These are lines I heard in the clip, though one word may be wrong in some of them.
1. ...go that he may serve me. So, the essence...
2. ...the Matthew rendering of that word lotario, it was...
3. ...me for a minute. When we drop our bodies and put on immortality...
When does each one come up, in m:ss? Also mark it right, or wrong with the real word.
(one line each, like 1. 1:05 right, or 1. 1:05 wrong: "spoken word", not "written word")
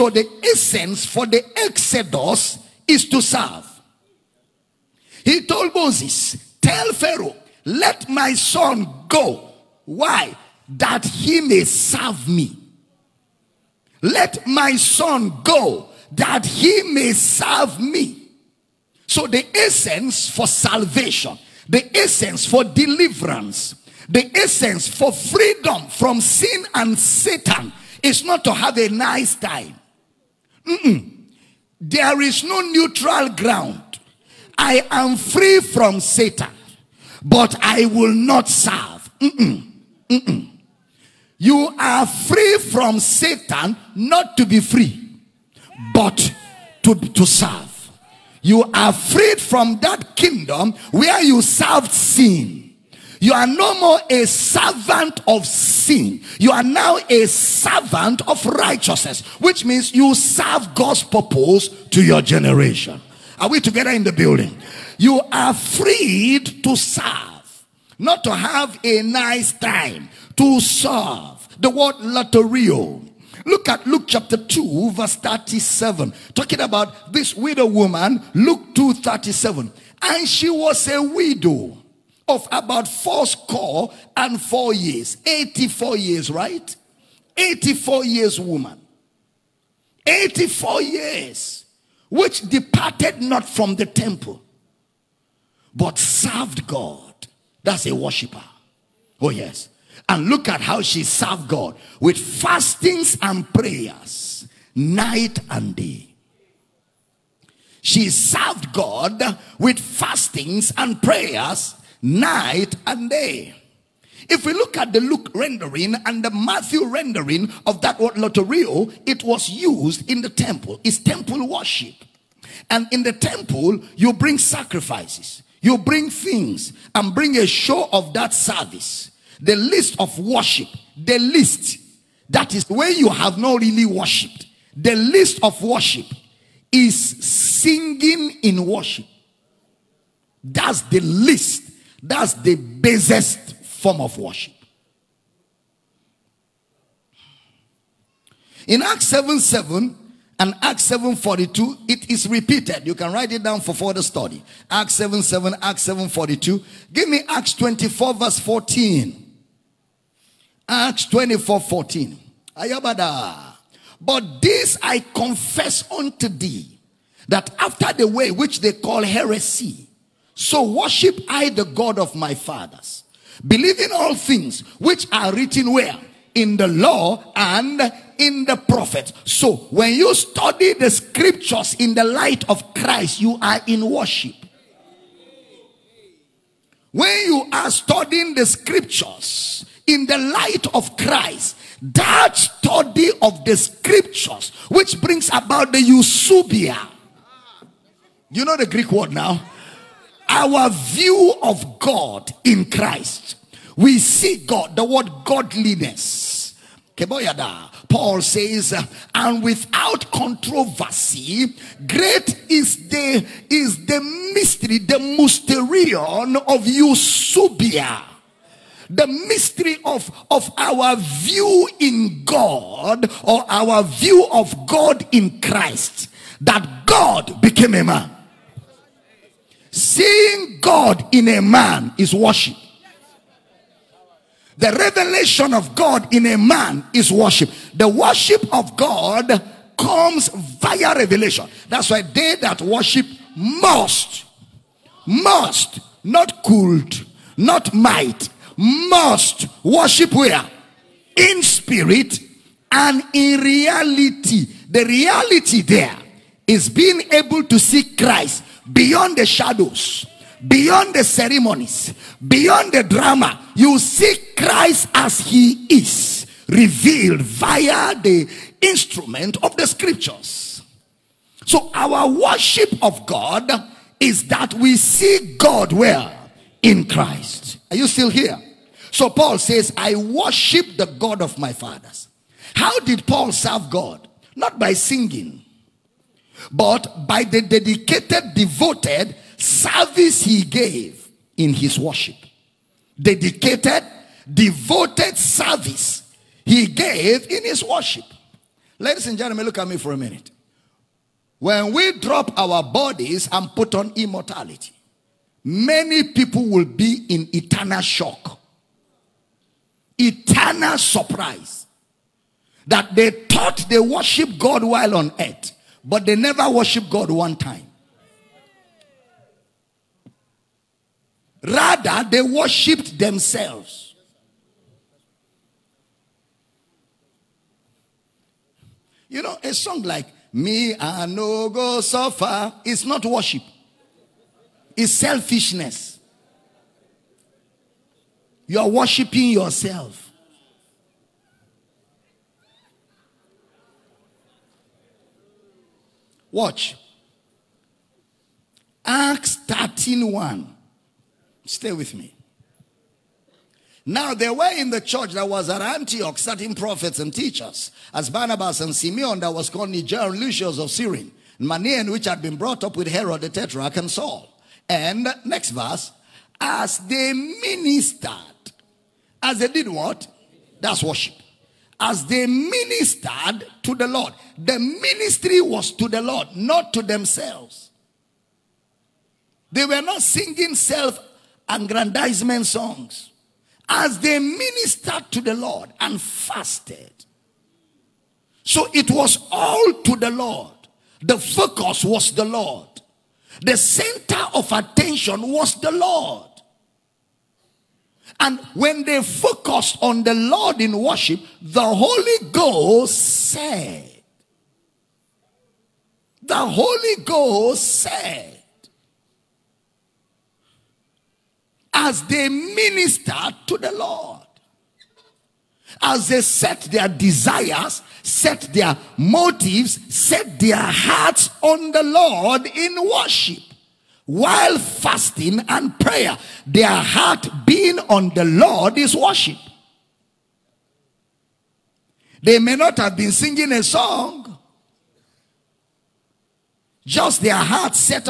1. 0:15 right
2. 1:56 right
3. 4:59 right.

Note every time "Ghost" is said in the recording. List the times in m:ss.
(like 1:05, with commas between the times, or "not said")
6:42, 6:47.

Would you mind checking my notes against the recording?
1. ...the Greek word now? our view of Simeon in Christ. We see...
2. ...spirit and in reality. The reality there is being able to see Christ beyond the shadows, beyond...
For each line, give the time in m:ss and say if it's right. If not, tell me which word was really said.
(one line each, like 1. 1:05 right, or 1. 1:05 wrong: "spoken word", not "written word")
1. 3:18 wrong: "God", not "Simeon"
2. 4:11 right.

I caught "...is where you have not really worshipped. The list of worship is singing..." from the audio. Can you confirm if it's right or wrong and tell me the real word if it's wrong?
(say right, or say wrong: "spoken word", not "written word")
right.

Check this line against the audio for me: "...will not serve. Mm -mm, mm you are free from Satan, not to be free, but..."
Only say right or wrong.
right.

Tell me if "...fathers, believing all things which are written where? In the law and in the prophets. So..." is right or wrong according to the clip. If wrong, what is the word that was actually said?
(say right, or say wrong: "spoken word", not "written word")
right.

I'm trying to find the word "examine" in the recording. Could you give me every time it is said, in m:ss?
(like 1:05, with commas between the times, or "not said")
not said.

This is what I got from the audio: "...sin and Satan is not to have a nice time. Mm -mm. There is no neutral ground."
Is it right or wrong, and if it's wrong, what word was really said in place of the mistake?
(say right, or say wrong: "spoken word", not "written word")
right.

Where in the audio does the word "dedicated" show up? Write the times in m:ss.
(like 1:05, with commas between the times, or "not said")
4:47, 4:53.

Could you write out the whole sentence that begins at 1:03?
Are we together in the building?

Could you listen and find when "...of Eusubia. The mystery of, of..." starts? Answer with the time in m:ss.
3:36.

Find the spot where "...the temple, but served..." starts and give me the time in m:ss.
1:33.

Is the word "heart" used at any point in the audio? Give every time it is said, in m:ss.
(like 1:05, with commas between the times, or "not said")
7:00, 7:06, 7:17.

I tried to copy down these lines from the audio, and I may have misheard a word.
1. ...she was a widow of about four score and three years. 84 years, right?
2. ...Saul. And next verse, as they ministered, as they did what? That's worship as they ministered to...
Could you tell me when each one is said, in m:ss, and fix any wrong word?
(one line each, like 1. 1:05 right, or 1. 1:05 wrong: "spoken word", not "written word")
1. 1:20 wrong: "four", not "three"
2. 6:03 right.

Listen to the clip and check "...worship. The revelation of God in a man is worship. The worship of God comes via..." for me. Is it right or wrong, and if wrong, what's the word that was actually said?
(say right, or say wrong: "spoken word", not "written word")
right.